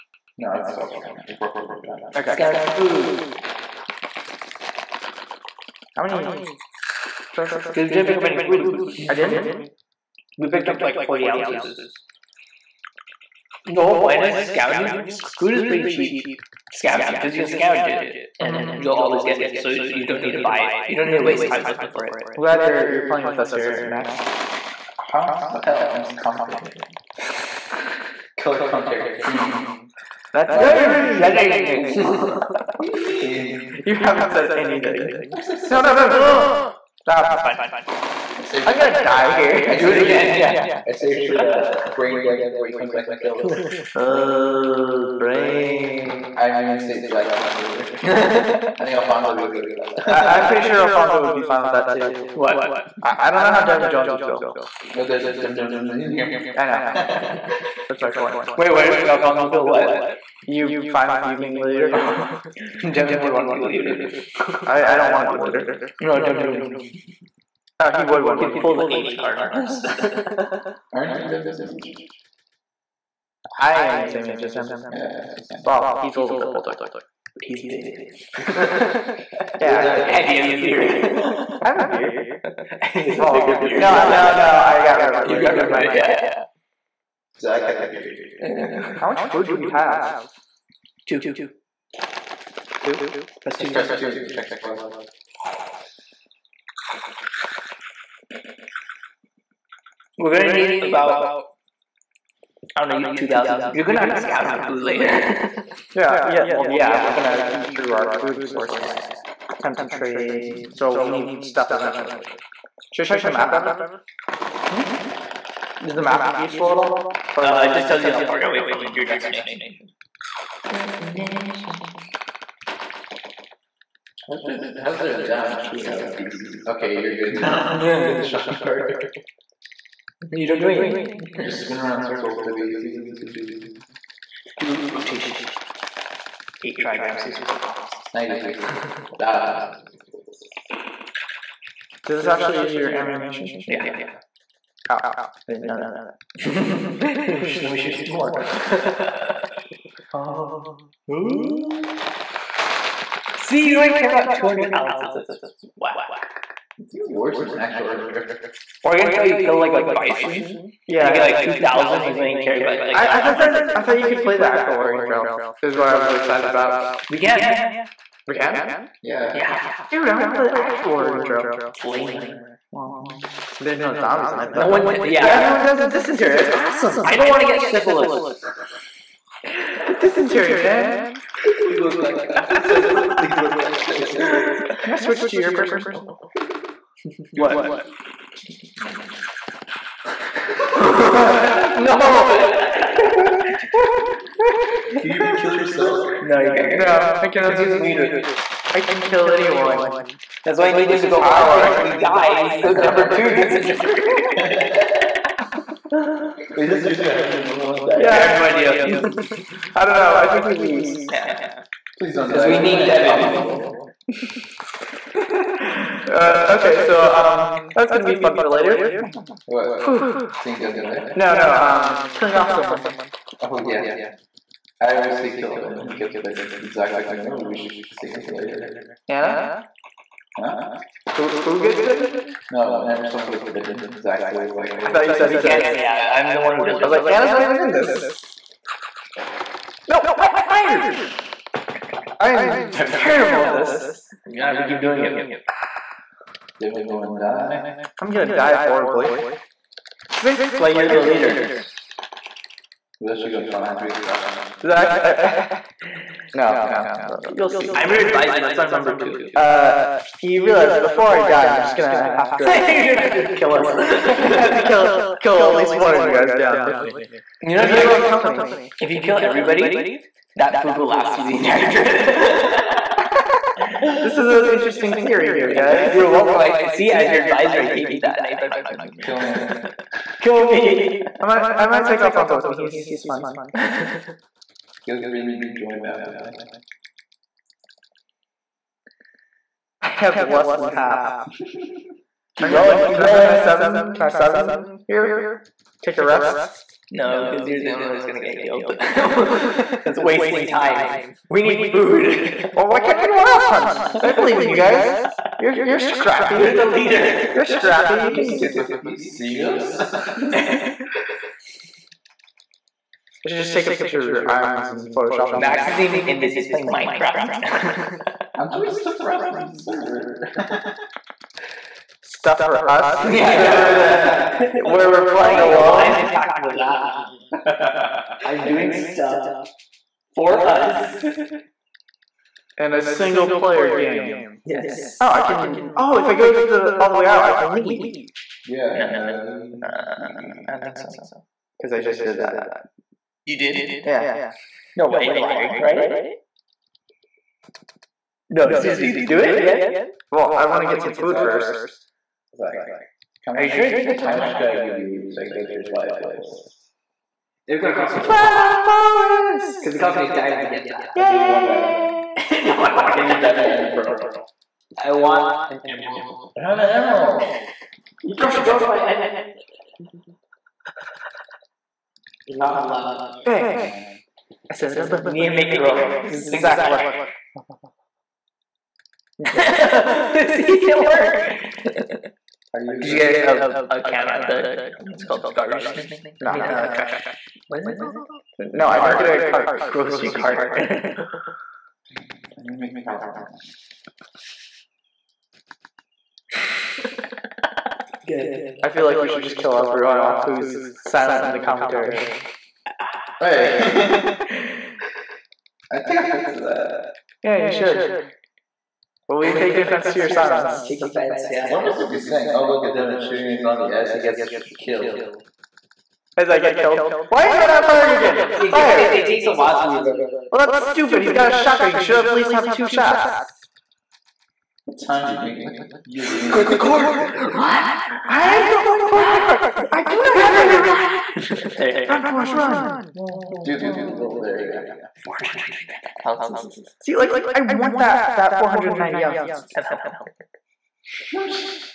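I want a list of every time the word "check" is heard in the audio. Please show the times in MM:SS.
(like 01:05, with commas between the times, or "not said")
01:34, 01:53.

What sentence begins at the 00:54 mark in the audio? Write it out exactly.
No, there's Devin Jones isn't in here.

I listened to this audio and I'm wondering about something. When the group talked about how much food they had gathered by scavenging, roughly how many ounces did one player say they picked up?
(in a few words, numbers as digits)
40 ounces.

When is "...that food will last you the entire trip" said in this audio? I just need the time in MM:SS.
04:30.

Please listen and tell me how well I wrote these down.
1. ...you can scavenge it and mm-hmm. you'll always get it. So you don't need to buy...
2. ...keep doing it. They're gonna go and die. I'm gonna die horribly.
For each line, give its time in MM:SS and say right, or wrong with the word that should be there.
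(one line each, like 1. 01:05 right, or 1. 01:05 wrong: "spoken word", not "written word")
1. 00:17 right
2. 04:04 right.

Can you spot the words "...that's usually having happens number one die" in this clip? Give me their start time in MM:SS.
03:26.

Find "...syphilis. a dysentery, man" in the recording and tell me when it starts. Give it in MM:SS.
02:57.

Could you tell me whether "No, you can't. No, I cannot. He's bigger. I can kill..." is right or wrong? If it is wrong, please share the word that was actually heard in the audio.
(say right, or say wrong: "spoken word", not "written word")
wrong: "leader", not "bigger".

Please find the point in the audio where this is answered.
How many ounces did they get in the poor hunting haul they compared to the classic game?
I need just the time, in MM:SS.
02:34.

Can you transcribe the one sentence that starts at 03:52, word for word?
No, whenever someone gets bitten, Zach's always like, oh, I thought you said we can't.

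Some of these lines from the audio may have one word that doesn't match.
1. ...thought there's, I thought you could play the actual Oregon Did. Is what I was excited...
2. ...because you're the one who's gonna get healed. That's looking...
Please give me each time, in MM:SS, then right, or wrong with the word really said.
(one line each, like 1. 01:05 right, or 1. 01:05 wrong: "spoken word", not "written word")
1. 02:43 wrong: "Trail", not "Did"
2. 04:57 wrong: "wasting", not "looking".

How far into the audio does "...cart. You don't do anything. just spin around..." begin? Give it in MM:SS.
02:08.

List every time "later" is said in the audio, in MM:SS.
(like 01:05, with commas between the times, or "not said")
01:44, 03:38, 03:48.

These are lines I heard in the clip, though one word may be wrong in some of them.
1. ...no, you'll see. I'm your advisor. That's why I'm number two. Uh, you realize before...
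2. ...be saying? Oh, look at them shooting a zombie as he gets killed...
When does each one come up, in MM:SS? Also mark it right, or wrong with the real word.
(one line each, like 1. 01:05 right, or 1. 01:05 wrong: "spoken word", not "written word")
1. 04:17 right
2. 06:51 right.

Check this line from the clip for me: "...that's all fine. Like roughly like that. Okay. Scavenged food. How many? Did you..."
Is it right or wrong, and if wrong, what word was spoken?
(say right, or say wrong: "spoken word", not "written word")
right.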